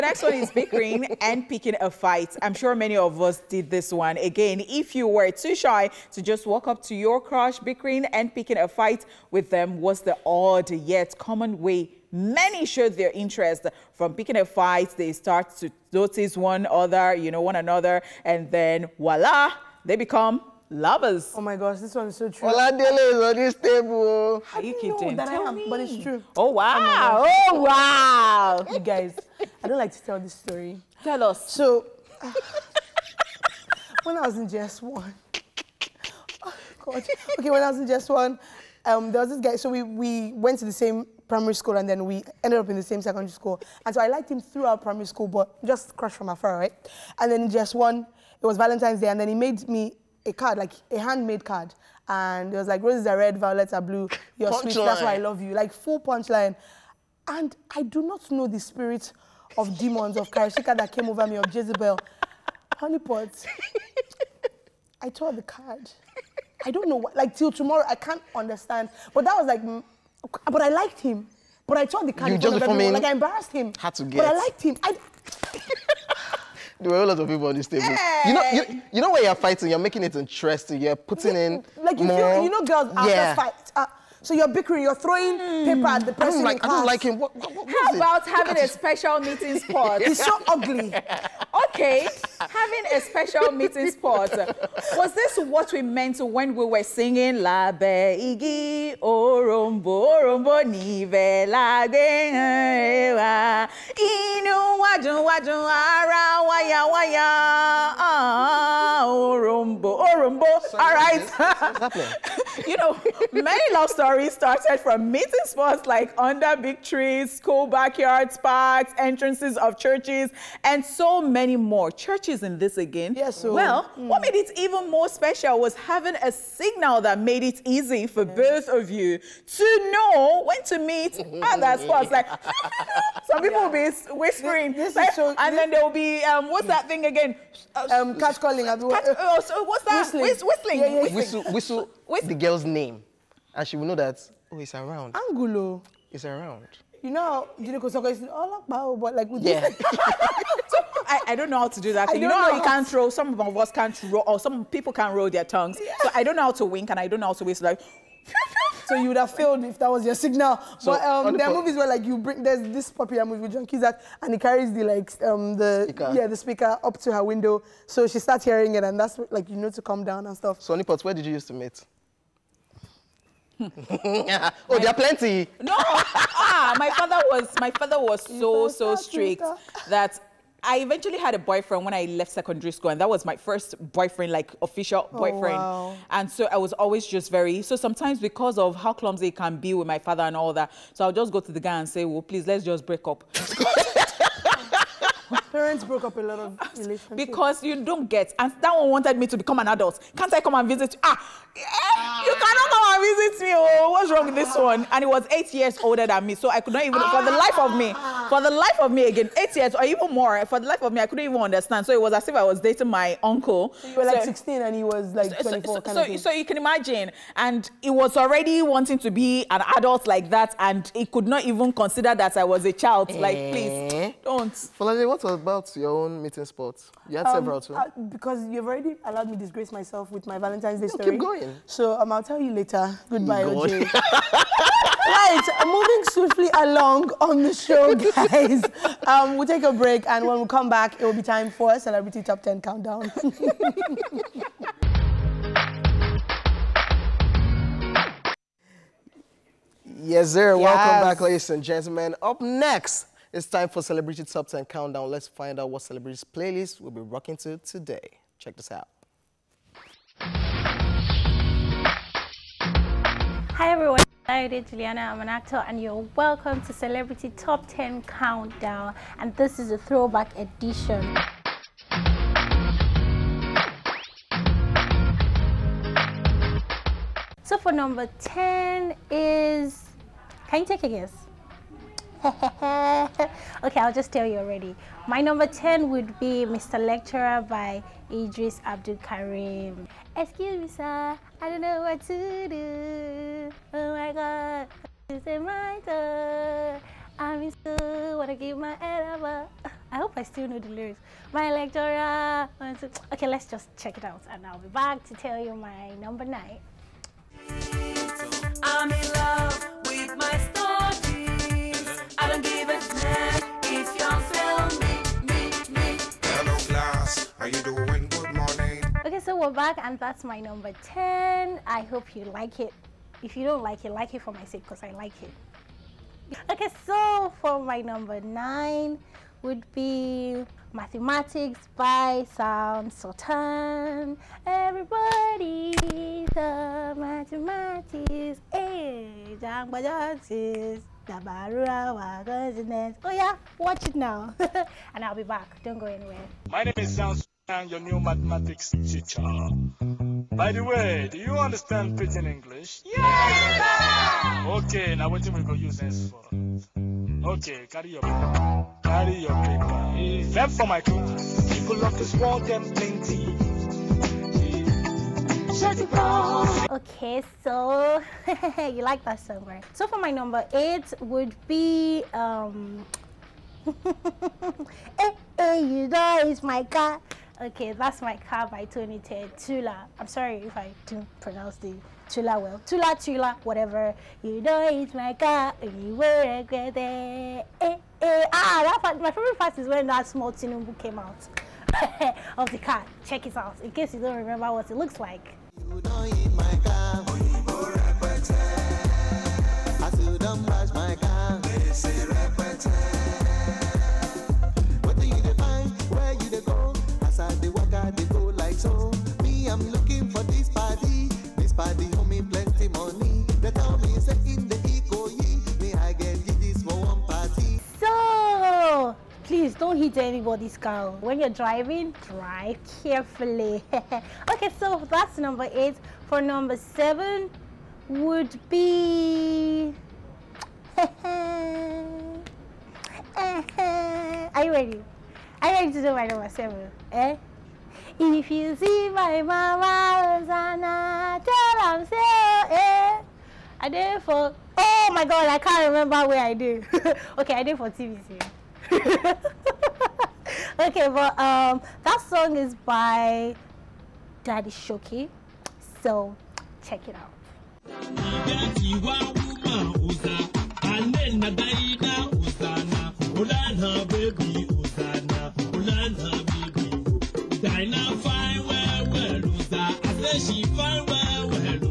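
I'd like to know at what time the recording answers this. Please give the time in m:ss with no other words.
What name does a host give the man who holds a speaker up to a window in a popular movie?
2:43.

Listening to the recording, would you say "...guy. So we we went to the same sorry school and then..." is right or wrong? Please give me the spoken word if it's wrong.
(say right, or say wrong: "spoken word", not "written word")
wrong: "primary", not "sorry".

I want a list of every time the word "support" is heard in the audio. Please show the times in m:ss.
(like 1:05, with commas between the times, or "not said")
not said.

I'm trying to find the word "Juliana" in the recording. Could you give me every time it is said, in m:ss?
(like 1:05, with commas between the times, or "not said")
4:24.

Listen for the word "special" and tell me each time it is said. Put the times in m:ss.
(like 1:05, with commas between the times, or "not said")
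1:28, 1:33, 2:05.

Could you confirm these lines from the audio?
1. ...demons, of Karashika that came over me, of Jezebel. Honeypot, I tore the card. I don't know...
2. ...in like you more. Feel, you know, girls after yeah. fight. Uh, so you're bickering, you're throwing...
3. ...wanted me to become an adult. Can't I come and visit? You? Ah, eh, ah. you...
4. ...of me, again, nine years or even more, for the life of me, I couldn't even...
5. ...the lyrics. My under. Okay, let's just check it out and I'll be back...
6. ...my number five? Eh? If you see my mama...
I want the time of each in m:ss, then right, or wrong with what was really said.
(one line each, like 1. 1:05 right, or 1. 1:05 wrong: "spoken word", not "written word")
1. 0:59 right
2. 1:21 right
3. 3:18 right
4. 3:28 wrong: "eight", not "nine"
5. 5:00 wrong: "lecturer", not "under"
6. 7:15 wrong: "seven", not "five".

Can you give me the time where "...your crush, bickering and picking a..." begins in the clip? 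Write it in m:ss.
0:06.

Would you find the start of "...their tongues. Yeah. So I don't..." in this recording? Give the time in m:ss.
2:35.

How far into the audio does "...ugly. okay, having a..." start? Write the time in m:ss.
1:30.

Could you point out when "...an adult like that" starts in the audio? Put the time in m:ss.
3:39.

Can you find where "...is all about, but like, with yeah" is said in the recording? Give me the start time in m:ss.
2:28.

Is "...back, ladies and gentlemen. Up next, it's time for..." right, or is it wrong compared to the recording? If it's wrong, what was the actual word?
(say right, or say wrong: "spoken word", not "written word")
right.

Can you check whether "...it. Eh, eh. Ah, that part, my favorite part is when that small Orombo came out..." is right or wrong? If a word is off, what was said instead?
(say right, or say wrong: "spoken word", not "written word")
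wrong: "Tinubu", not "Orombo".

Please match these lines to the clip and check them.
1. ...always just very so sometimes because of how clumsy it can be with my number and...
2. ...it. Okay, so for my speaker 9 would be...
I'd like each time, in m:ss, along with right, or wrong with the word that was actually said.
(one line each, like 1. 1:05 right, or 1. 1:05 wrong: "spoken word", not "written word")
1. 3:06 wrong: "father", not "number"
2. 5:25 wrong: "number", not "speaker".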